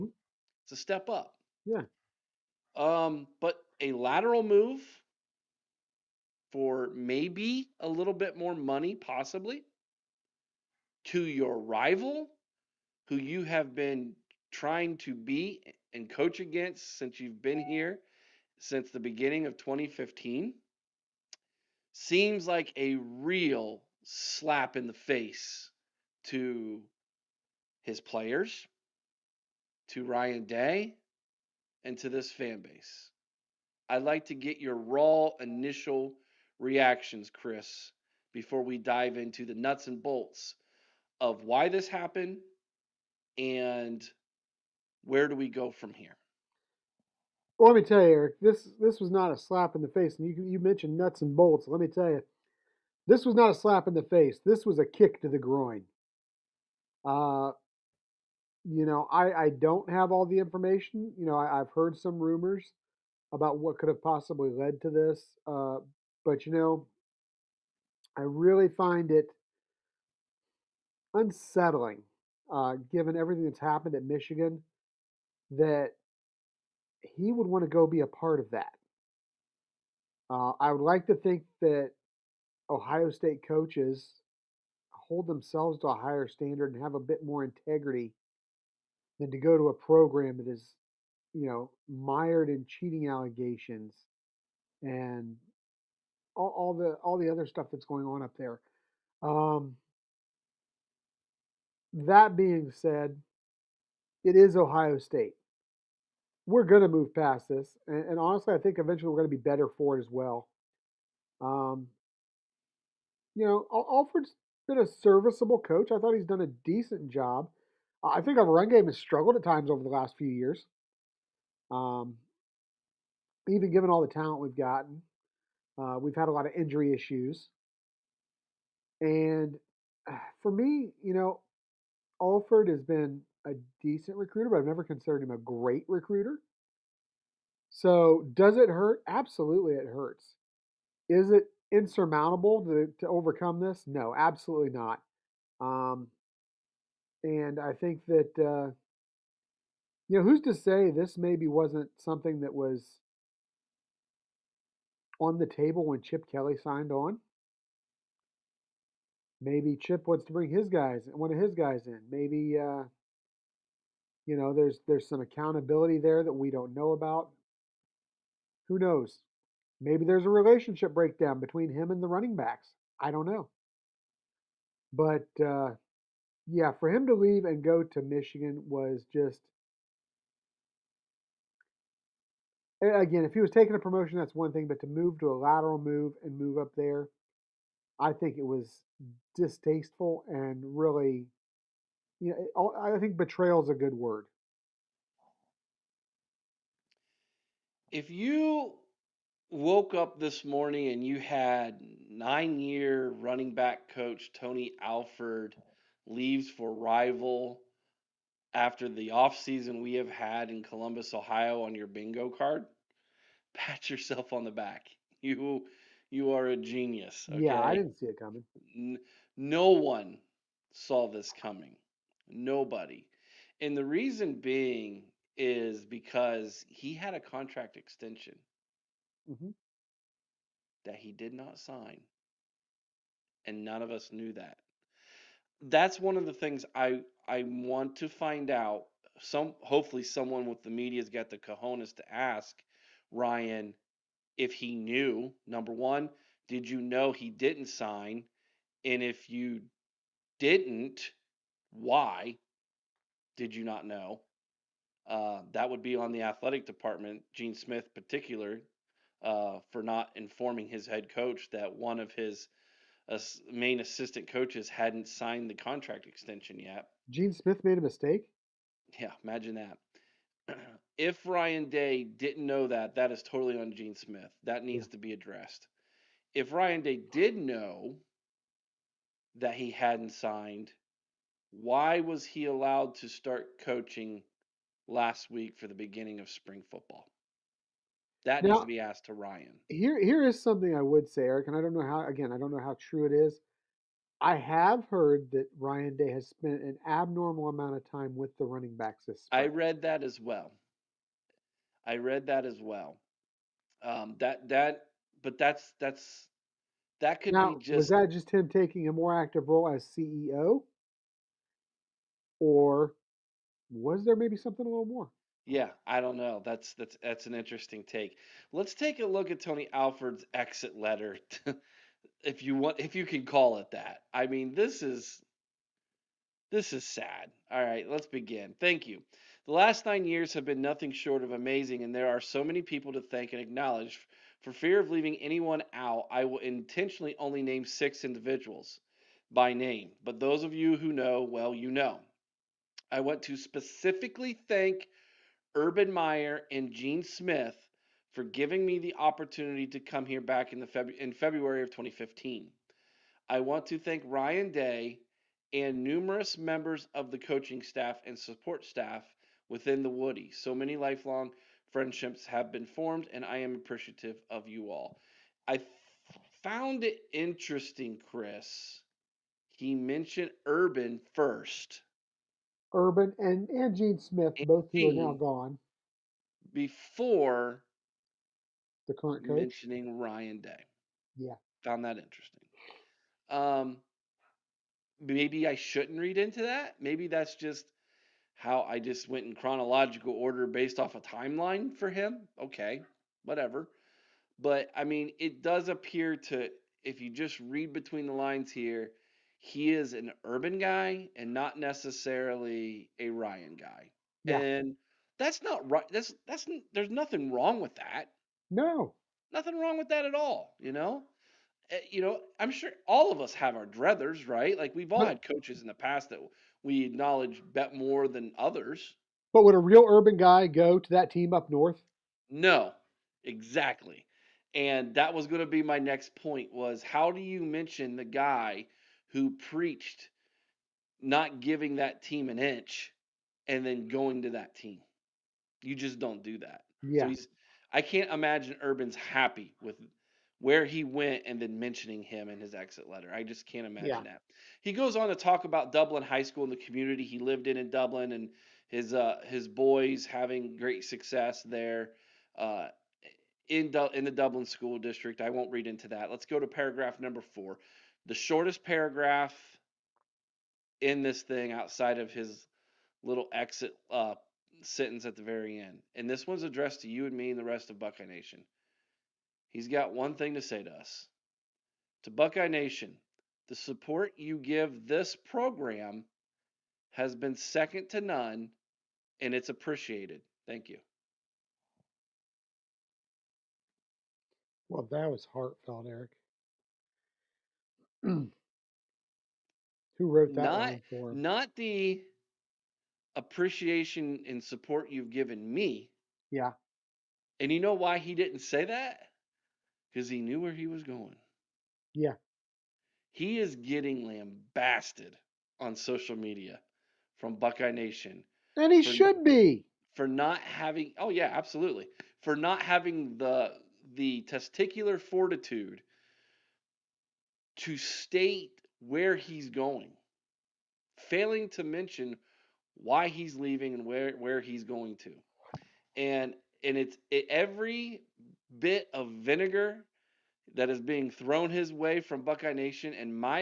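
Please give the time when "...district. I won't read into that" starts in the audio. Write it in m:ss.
7:34.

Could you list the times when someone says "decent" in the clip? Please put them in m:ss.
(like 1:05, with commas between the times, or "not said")
1:56, 2:13.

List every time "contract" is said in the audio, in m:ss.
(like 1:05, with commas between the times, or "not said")
3:47, 4:25.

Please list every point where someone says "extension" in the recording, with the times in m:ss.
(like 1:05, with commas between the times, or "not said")
3:47, 4:26.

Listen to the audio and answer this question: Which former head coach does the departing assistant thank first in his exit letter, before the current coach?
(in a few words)
Urban Meyer.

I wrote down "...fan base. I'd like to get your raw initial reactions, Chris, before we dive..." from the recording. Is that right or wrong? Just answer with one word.
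right.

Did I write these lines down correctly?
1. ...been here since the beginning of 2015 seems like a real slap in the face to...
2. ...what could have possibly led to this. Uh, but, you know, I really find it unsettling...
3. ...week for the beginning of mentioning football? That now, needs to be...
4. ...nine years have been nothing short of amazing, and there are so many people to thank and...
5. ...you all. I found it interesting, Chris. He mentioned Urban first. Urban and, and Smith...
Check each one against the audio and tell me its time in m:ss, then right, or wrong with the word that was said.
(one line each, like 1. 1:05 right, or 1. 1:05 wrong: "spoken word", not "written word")
1. 0:17 right
2. 1:03 right
3. 4:45 wrong: "spring", not "mentioning"
4. 5:29 right
5. 6:04 wrong: "Gene", not "Smith".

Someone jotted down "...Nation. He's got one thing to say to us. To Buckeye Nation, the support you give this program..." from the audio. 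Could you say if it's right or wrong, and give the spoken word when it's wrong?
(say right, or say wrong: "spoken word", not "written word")
right.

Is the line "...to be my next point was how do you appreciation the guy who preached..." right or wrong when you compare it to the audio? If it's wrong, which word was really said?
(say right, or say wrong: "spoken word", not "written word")
wrong: "mention", not "appreciation".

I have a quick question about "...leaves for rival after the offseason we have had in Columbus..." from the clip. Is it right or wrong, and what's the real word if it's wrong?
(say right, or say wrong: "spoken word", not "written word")
right.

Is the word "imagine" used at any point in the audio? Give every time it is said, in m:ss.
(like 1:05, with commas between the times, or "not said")
4:29, 7:18, 7:23.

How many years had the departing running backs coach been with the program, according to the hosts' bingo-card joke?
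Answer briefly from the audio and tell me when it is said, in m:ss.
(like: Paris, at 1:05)
9, at 3:22.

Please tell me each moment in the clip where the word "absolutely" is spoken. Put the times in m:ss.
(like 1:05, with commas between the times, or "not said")
2:19, 2:24, 8:31.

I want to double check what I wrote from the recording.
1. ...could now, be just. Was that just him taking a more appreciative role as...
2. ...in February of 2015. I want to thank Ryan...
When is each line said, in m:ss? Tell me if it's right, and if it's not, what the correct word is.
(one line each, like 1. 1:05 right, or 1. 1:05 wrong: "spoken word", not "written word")
1. 5:07 wrong: "active", not "appreciative"
2. 5:50 right.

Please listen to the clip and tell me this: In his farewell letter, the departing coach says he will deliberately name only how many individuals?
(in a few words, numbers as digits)
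6.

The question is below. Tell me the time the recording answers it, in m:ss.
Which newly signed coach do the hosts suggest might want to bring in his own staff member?
2:36.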